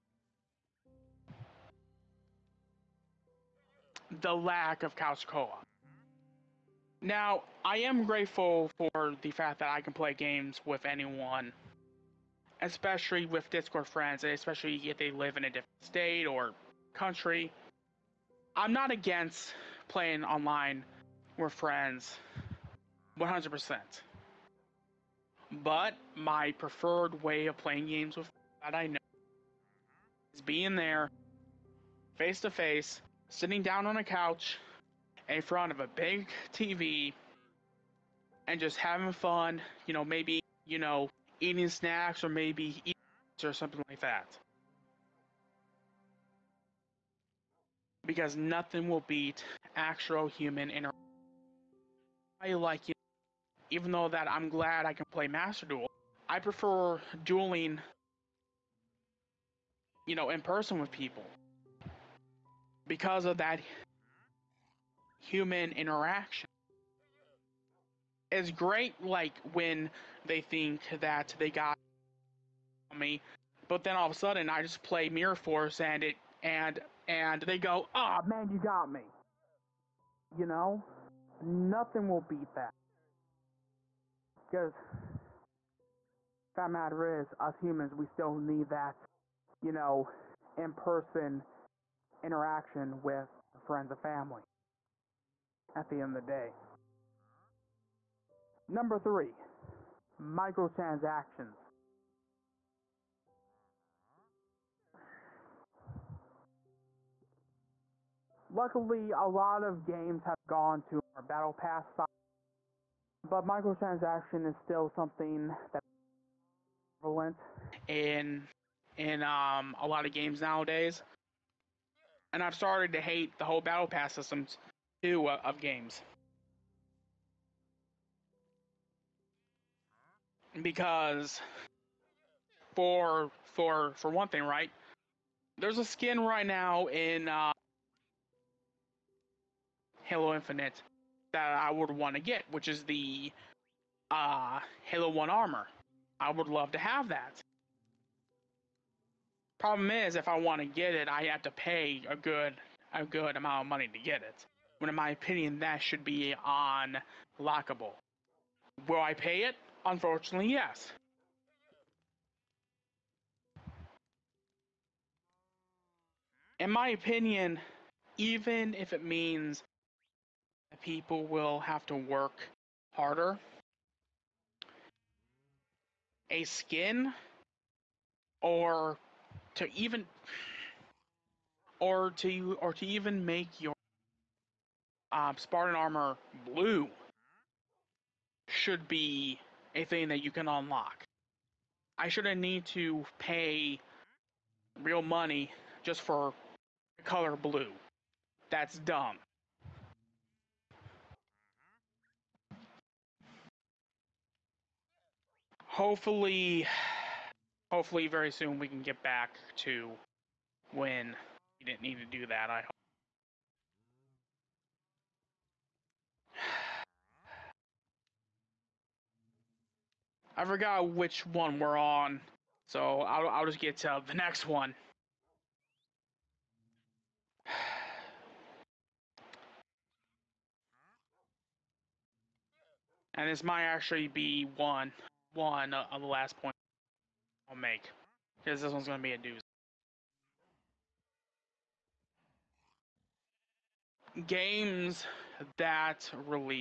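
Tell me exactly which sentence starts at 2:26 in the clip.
I would love to have that.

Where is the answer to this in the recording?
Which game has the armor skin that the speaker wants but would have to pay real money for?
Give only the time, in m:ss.
2:20.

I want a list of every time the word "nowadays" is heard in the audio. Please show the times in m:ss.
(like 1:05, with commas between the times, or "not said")
2:00.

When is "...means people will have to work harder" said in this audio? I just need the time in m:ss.
2:49.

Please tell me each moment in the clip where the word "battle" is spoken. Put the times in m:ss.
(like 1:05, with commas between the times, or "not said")
1:51, 2:03.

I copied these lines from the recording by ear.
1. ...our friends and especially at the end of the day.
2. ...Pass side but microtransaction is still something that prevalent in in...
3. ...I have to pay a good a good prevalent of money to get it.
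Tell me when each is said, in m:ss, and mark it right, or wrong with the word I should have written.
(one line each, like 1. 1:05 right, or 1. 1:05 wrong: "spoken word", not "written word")
1. 1:33 wrong: "family", not "especially"
2. 1:51 right
3. 2:31 wrong: "amount", not "prevalent".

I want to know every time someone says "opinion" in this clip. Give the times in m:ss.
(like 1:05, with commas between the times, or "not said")
2:35, 2:46.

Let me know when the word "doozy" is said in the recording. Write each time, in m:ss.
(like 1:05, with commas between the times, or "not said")
3:59.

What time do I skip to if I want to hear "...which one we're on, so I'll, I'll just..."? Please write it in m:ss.
3:40.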